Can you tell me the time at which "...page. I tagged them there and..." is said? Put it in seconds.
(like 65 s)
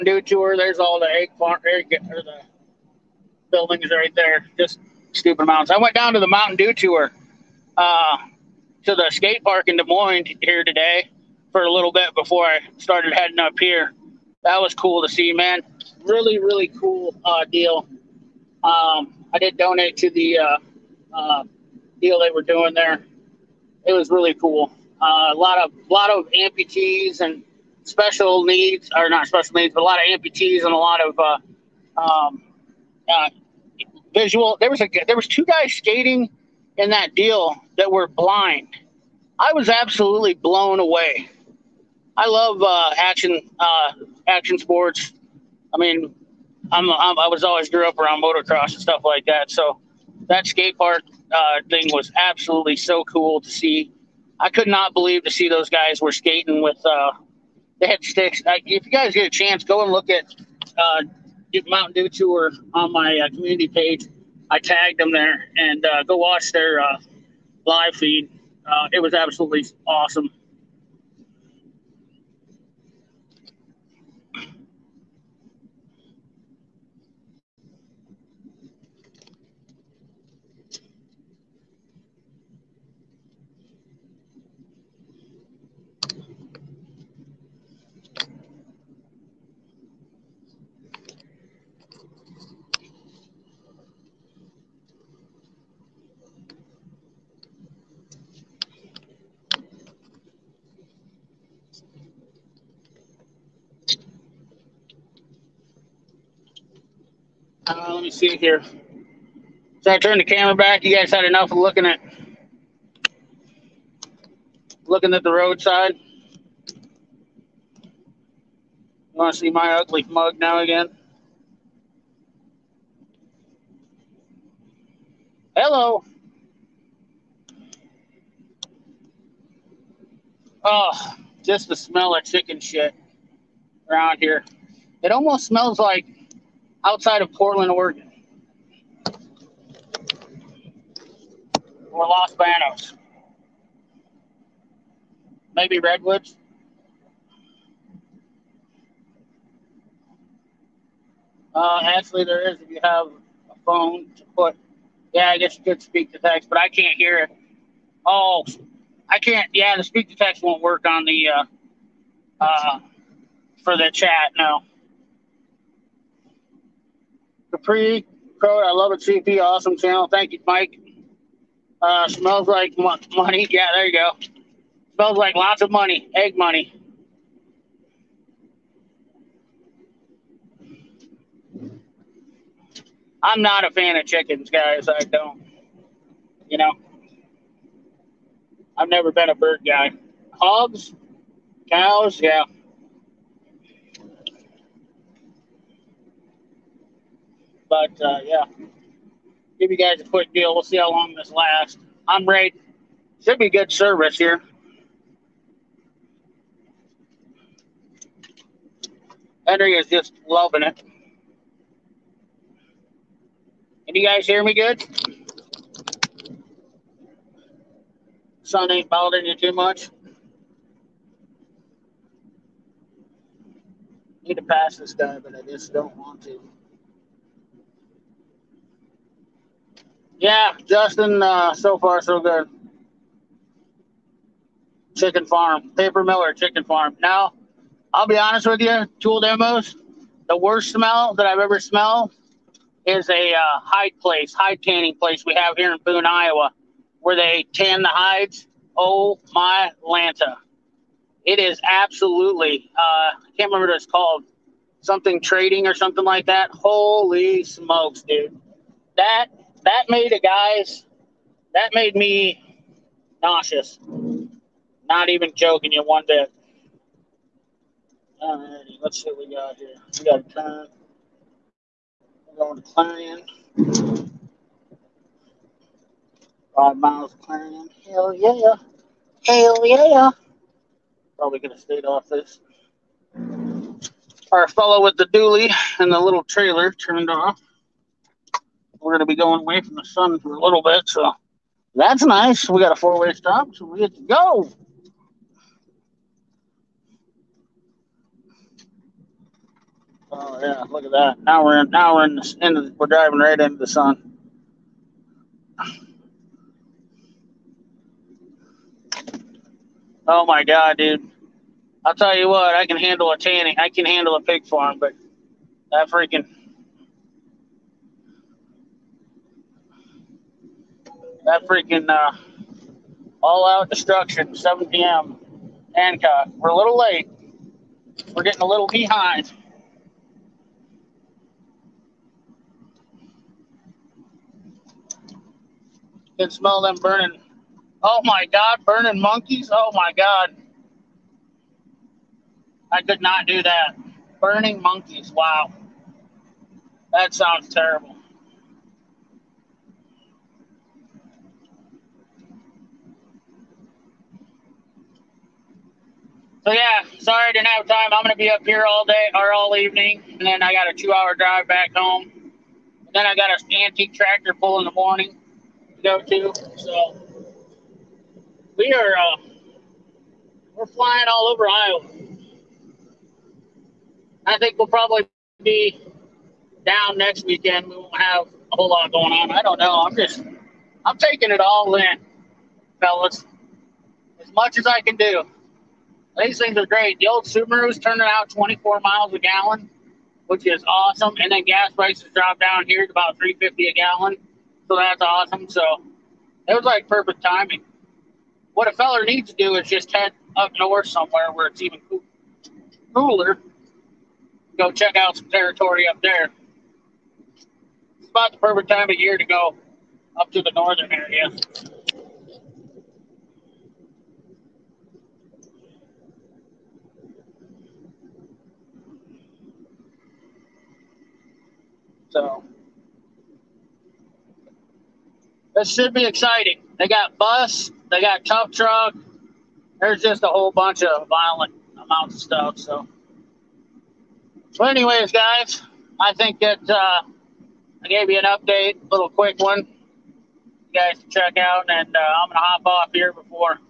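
63 s.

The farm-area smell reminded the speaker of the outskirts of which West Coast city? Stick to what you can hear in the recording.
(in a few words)
Portland, Oregon.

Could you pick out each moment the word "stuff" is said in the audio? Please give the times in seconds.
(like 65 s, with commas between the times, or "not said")
48 s, 432 s.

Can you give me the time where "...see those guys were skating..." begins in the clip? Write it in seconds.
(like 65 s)
55 s.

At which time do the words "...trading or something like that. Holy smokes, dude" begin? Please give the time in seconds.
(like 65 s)
255 s.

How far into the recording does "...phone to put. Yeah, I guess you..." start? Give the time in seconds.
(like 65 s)
153 s.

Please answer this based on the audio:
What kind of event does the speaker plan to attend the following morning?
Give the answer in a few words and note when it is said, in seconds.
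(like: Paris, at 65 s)
antique tractor pull, at 363 s.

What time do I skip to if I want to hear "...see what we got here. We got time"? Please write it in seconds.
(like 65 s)
269 s.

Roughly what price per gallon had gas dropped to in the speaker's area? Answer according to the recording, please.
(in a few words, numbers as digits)
$3.50.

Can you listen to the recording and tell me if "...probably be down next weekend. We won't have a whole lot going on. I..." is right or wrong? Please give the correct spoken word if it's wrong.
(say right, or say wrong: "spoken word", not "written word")
right.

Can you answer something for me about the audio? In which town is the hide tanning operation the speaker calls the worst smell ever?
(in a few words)
Boone, Iowa.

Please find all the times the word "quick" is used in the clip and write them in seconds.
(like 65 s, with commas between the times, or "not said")
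200 s, 439 s.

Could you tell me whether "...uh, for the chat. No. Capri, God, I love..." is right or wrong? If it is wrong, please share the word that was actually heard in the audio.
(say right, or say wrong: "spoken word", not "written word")
wrong: "Code", not "God".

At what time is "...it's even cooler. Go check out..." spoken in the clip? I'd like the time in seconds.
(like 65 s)
401 s.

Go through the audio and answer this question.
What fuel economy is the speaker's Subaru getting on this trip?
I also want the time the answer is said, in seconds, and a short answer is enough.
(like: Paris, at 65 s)
24 miles a gallon, at 388 s.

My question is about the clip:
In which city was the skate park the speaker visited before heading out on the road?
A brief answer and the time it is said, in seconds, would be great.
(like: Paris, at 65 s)
Des Moines, at 9 s.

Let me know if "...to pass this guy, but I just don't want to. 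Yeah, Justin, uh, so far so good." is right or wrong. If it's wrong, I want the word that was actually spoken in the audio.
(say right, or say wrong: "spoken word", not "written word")
right.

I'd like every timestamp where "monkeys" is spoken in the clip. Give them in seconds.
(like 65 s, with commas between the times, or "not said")
339 s, 344 s.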